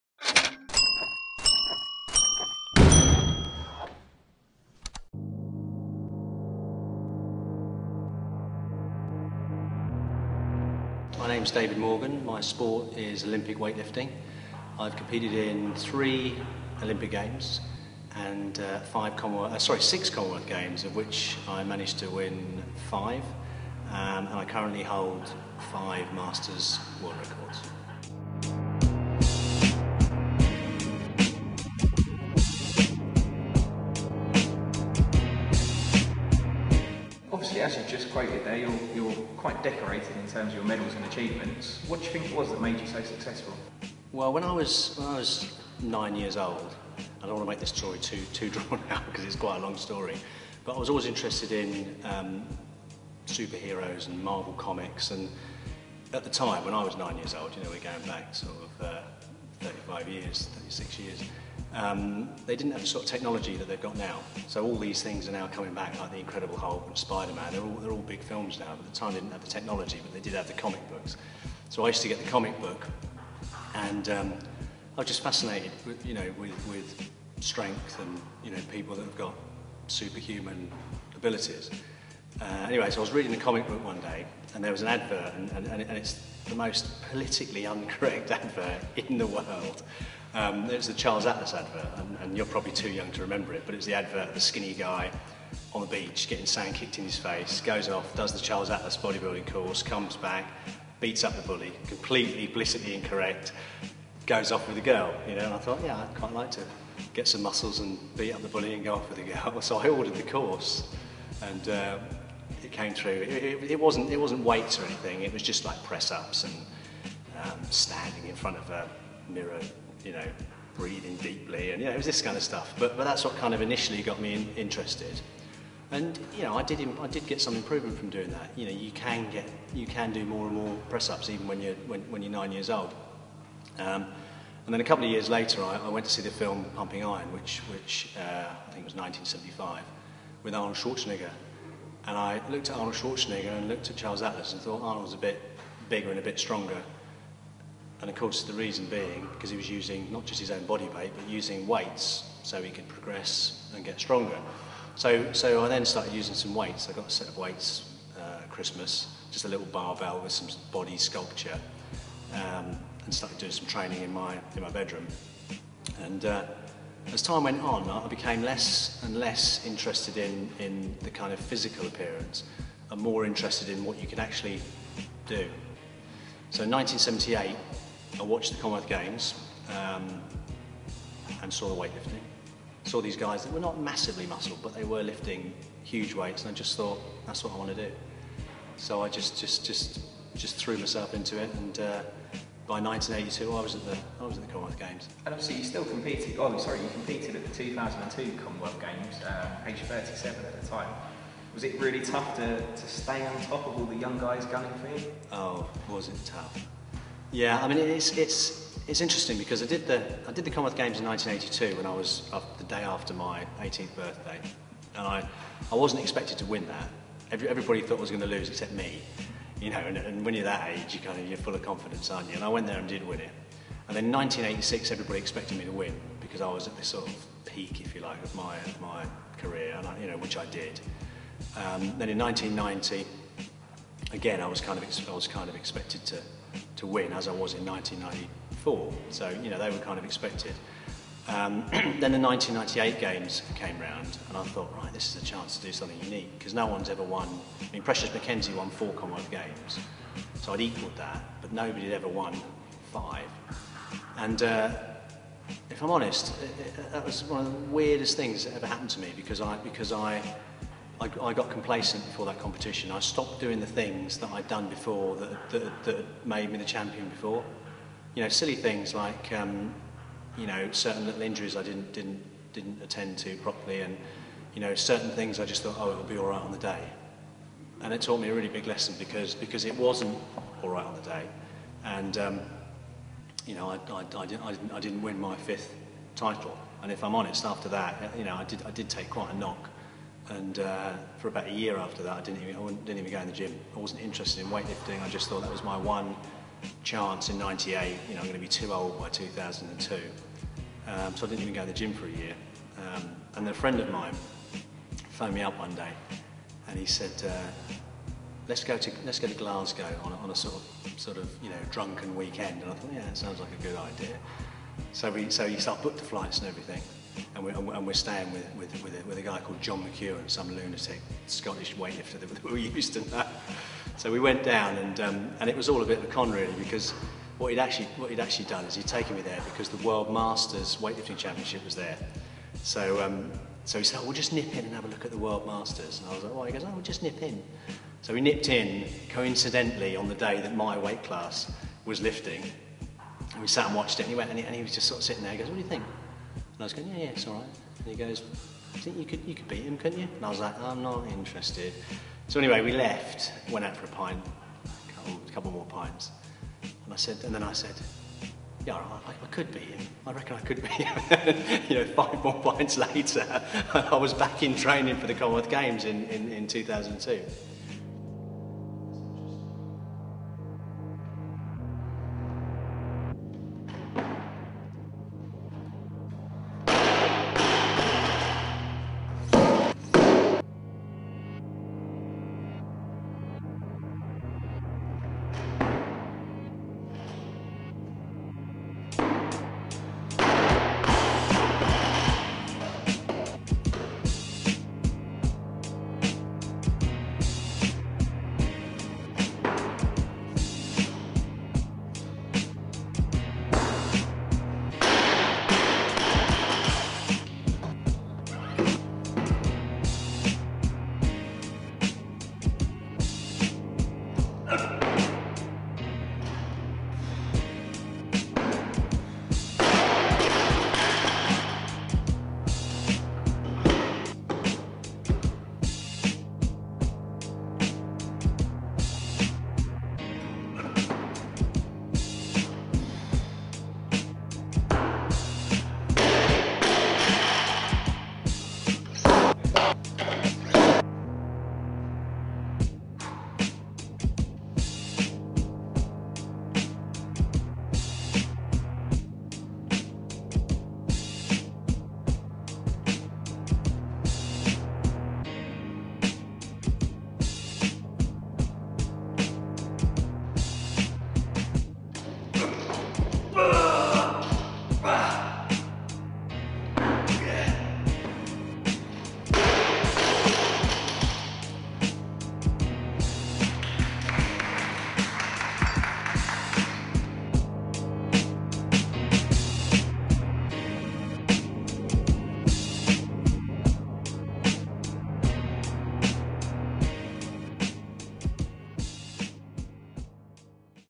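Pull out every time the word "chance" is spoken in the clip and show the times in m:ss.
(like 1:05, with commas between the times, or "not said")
4:05, 4:56.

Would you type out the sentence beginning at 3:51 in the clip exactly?
Um, then in 1990, again, I was kind of, I was kind of expected to, to win as I was in 1994.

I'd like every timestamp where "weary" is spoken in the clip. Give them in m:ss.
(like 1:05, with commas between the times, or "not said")
not said.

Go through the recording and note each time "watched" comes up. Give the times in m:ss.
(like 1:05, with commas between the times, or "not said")
2:58, 5:43.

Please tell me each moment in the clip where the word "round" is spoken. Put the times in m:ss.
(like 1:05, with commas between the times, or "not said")
4:03.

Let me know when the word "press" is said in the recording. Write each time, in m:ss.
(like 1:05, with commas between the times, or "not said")
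1:55, 2:10.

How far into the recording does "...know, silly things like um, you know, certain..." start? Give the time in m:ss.
4:28.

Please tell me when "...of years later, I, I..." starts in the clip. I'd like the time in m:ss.
2:15.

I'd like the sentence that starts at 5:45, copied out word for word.
He goes, what do you think?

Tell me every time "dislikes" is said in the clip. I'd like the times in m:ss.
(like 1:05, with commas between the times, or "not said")
not said.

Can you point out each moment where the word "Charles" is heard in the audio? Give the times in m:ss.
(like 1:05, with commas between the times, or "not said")
1:30, 1:38, 2:23.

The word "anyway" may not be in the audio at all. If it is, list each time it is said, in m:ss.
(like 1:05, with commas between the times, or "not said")
1:22, 5:52.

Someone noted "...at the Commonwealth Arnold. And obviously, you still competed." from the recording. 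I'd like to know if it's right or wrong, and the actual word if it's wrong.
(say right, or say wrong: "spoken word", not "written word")
wrong: "Games", not "Arnold".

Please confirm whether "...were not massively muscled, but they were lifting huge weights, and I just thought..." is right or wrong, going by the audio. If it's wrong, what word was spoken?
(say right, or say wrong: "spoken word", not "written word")
right.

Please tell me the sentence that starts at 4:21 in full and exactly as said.
I got complacent before that competition.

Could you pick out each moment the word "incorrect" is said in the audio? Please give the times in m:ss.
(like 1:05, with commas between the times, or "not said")
1:27, 1:42.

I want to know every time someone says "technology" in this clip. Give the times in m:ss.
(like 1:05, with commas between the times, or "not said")
1:03, 1:09.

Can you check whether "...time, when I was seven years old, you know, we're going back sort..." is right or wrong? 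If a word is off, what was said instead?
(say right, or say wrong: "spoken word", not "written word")
wrong: "nine", not "seven".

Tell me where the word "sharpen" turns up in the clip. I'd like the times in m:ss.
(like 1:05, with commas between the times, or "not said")
not said.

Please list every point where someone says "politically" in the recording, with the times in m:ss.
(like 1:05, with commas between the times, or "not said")
1:27.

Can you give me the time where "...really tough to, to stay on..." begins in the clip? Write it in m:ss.
3:21.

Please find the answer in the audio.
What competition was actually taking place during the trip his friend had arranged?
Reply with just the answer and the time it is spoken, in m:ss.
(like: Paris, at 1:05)
World Masters Weightlifting Championship, at 5:29.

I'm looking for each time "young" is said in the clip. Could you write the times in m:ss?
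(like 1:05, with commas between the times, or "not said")
1:32, 3:23.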